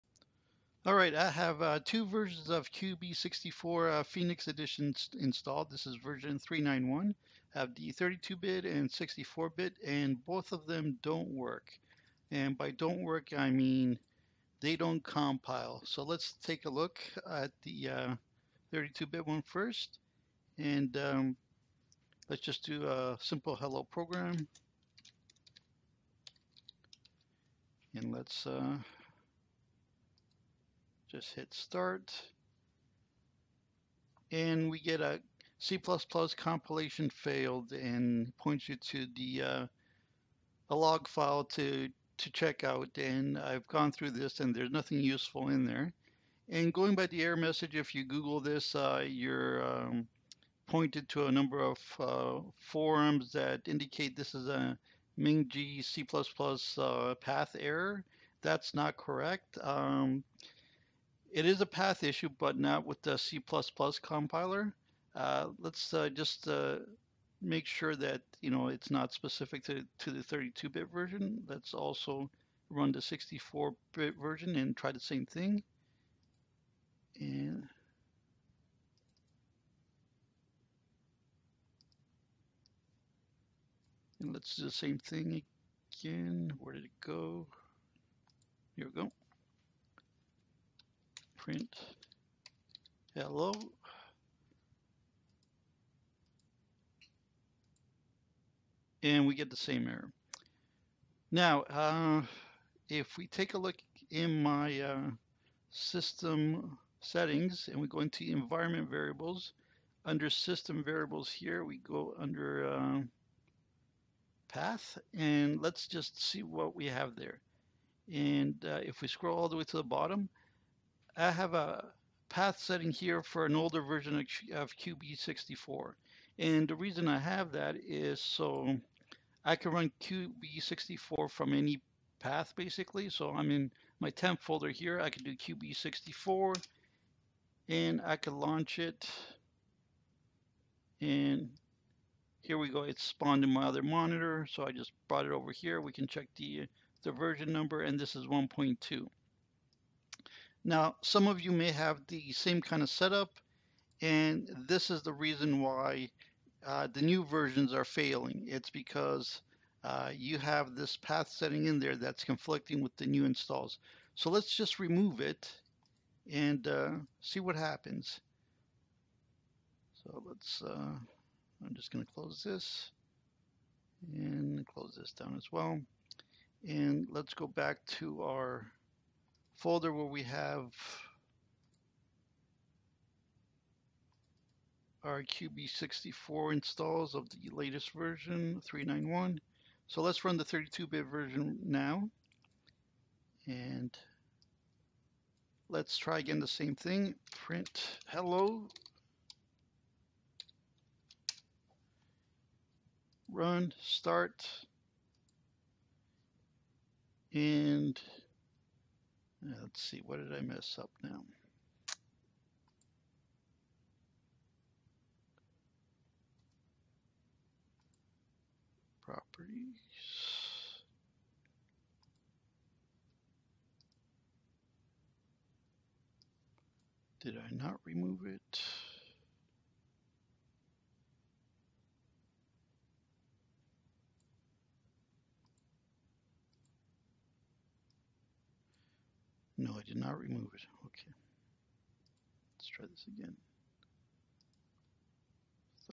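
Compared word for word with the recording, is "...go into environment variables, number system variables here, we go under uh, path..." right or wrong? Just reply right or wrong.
wrong.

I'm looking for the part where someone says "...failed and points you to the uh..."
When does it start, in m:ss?
0:37.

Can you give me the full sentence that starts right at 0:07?
I have the 32-bit and 64-bit, and both of them don't work.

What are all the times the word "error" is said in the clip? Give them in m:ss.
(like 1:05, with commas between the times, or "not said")
0:47, 0:57, 1:39.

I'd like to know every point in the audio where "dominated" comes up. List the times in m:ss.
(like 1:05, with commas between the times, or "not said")
not said.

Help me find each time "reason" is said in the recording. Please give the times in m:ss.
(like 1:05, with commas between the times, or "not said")
2:06, 2:35.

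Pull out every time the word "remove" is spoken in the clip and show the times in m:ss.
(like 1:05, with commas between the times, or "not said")
2:44, 3:47, 4:00.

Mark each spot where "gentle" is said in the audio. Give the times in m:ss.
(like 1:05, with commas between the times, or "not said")
not said.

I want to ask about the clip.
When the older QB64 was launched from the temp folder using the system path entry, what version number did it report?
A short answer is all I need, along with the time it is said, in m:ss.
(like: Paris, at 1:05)
1.2, at 2:28.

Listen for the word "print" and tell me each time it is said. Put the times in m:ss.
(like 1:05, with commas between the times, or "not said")
1:31, 3:17.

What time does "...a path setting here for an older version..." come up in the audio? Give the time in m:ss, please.
2:01.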